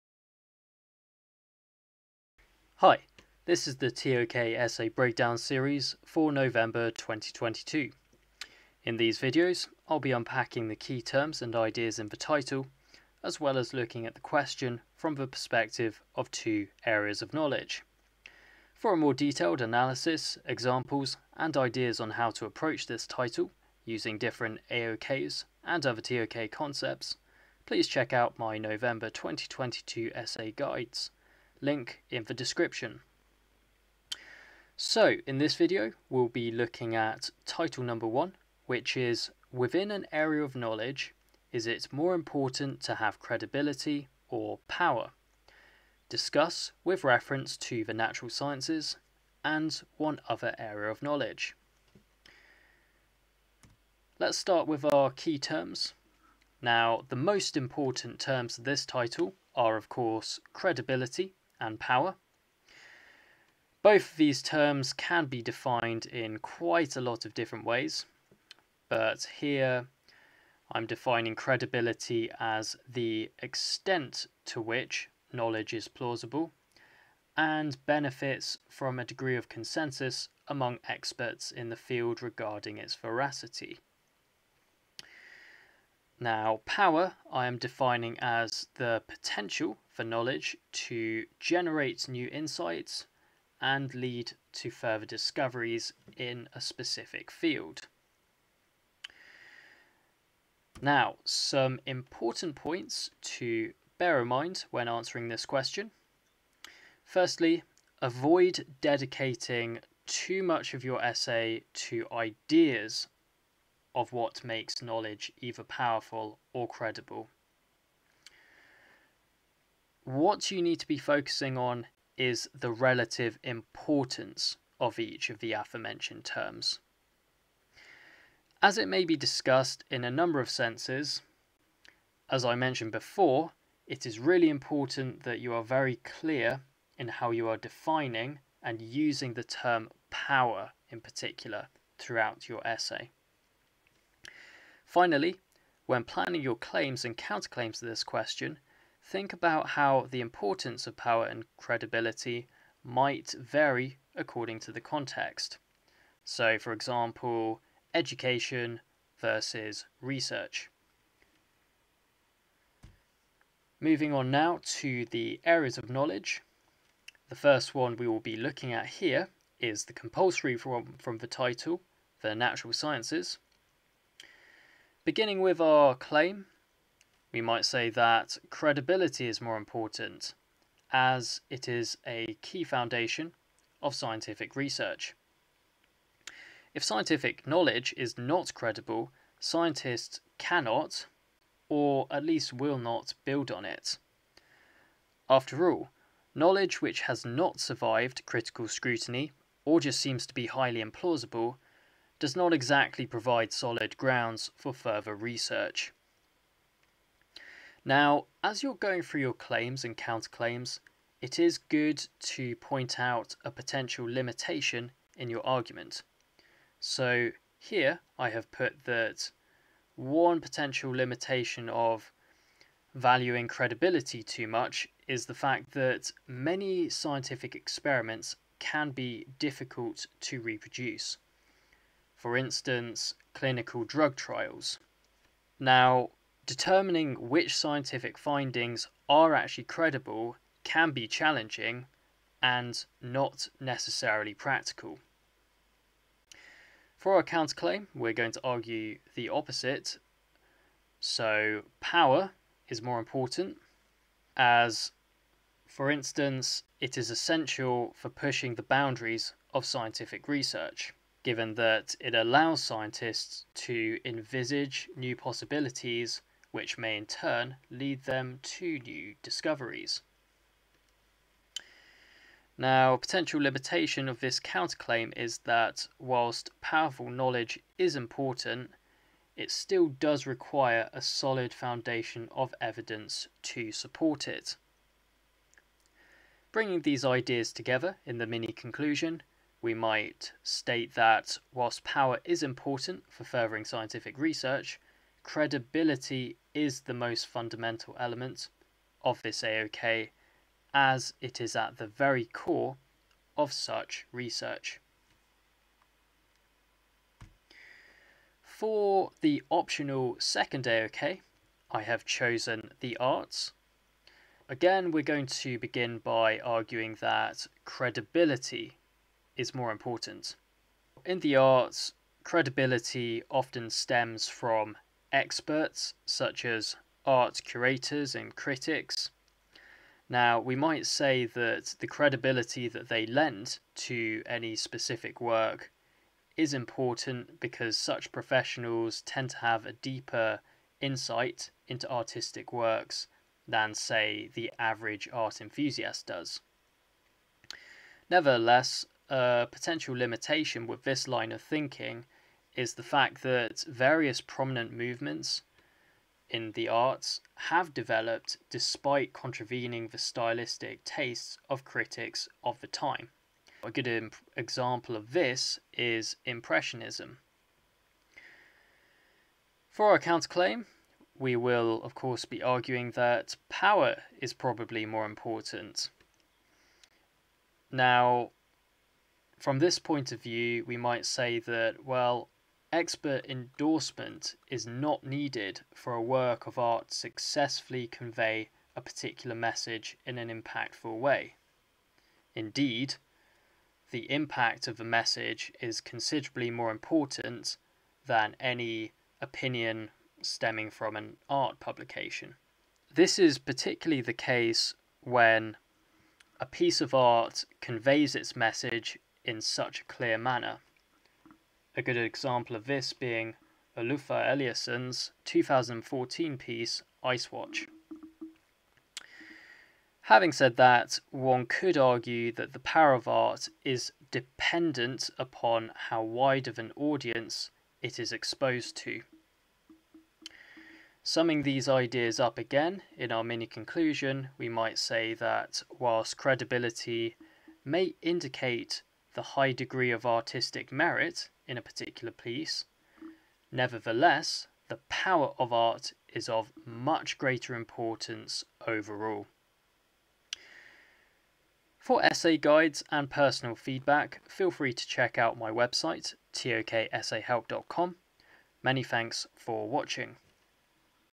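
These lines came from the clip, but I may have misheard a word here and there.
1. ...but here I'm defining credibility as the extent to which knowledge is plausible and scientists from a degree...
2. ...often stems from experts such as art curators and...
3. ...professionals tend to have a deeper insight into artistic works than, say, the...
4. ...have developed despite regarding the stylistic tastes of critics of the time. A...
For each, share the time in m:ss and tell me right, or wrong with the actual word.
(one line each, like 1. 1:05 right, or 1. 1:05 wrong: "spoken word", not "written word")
1. 1:08 wrong: "benefits", not "scientists"
2. 5:23 right
3. 5:38 right
4. 5:57 wrong: "contravening", not "regarding".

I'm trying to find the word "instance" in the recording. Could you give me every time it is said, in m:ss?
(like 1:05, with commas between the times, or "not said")
3:52, 4:15.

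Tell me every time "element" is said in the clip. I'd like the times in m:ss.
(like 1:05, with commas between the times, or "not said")
4:57.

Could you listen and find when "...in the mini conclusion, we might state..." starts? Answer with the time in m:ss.
4:48.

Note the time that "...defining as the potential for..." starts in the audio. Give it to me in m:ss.
1:27.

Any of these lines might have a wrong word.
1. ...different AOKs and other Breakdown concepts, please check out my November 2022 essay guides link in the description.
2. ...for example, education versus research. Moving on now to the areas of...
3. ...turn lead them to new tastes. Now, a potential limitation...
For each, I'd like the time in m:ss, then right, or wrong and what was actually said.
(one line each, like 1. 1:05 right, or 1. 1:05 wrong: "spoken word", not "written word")
1. 0:24 wrong: "TOK", not "Breakdown"
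2. 2:36 right
3. 4:27 wrong: "discoveries", not "tastes".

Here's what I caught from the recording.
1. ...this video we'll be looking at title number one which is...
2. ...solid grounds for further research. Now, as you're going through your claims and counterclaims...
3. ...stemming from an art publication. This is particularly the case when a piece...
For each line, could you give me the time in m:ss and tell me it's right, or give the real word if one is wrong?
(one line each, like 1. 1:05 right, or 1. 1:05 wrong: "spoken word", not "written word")
1. 0:35 right
2. 3:23 right
3. 6:40 right.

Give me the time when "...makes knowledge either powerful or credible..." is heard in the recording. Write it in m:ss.
1:54.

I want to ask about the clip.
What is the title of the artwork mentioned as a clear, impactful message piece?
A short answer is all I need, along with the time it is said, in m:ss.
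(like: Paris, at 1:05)
Ice Watch, at 6:57.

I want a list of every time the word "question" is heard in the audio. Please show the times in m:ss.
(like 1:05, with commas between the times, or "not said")
0:14, 1:45, 2:28.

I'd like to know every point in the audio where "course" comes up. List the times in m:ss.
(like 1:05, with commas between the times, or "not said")
0:59, 6:11.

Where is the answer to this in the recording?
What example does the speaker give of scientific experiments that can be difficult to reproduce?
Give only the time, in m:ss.
3:53.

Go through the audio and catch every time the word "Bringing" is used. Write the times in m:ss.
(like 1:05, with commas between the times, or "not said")
4:46.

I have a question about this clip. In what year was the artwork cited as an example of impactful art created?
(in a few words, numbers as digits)
2014.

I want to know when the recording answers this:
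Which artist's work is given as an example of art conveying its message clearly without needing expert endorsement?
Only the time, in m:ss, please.
6:53.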